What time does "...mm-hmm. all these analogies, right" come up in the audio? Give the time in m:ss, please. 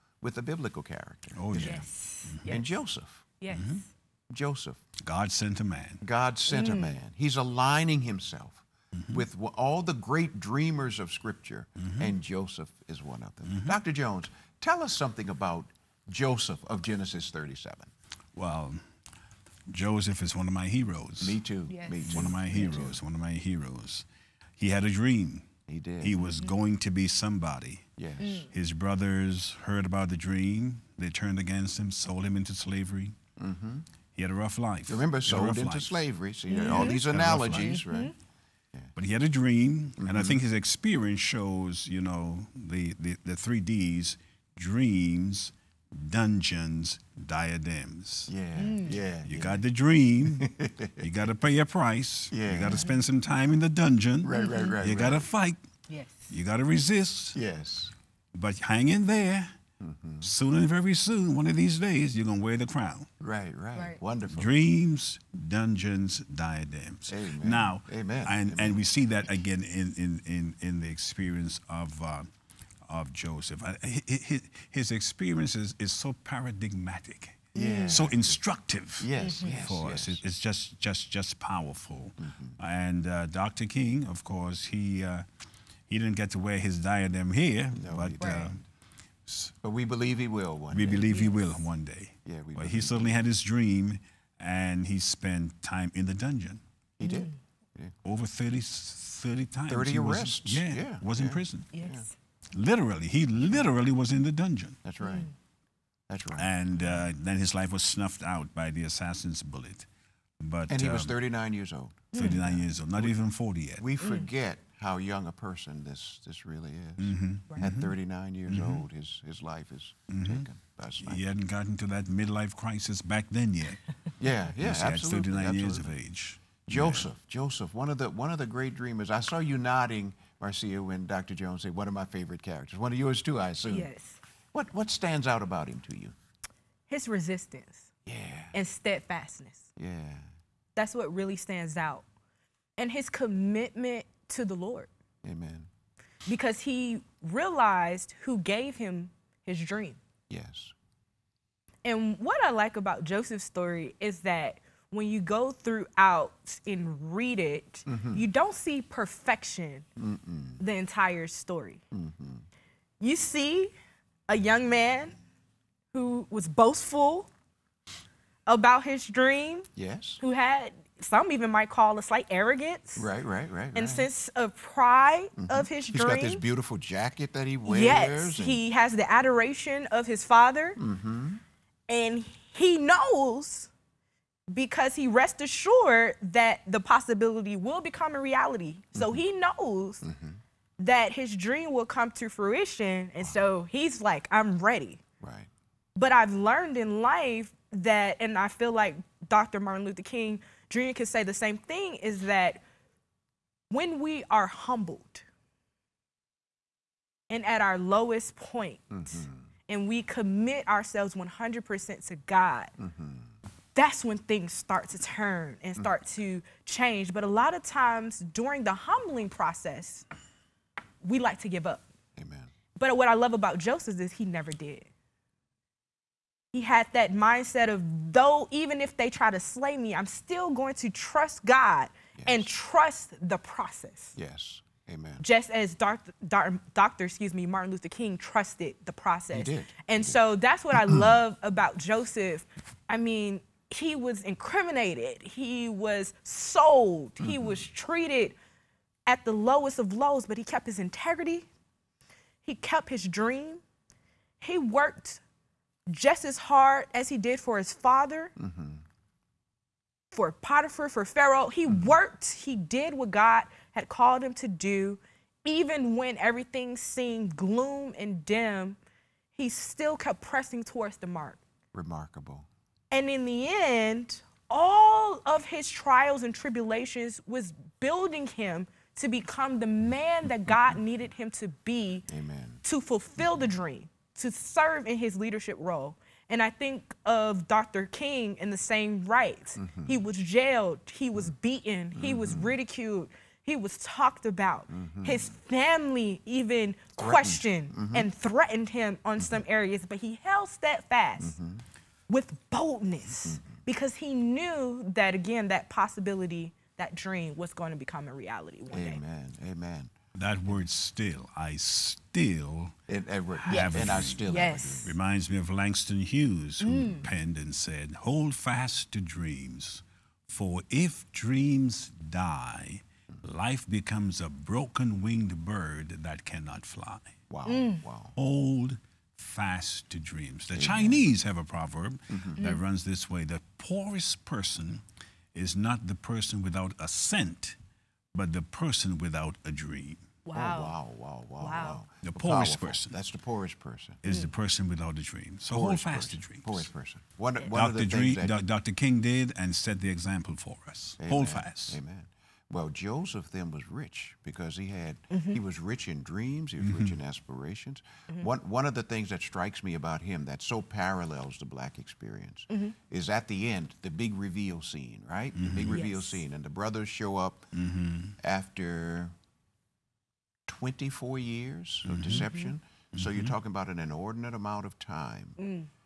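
0:36.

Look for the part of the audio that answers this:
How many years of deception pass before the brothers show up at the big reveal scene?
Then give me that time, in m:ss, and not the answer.
6:10.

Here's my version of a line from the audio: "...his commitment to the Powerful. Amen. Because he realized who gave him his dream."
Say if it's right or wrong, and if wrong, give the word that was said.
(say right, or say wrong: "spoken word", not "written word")
wrong: "Lord", not "Powerful".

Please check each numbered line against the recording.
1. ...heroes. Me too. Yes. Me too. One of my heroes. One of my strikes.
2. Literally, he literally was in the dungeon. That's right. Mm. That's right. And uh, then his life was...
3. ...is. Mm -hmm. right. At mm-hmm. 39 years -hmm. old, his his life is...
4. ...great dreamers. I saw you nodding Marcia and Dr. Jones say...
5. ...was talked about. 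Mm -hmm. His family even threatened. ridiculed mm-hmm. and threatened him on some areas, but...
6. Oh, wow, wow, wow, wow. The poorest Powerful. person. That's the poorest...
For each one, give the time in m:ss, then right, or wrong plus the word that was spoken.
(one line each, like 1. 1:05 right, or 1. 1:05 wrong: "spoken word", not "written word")
1. 0:20 wrong: "heroes", not "strikes"
2. 1:42 right
3. 1:56 right
4. 2:08 right
5. 4:53 wrong: "questioned", not "ridiculed"
6. 5:40 right.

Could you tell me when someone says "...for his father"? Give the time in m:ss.
4:17.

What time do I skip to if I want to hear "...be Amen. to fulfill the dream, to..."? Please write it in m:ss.
4:41.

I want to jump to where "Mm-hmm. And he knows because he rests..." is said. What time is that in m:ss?
3:00.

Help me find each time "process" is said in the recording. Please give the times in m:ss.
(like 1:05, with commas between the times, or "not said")
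3:39, 3:53, 3:58.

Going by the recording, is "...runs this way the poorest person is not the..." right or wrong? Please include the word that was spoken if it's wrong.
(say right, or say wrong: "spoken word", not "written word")
right.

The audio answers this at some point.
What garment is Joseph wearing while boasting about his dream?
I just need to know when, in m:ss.
2:56.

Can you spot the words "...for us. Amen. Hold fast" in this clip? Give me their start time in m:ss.
5:50.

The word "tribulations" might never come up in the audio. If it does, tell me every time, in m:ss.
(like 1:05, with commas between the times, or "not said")
4:36.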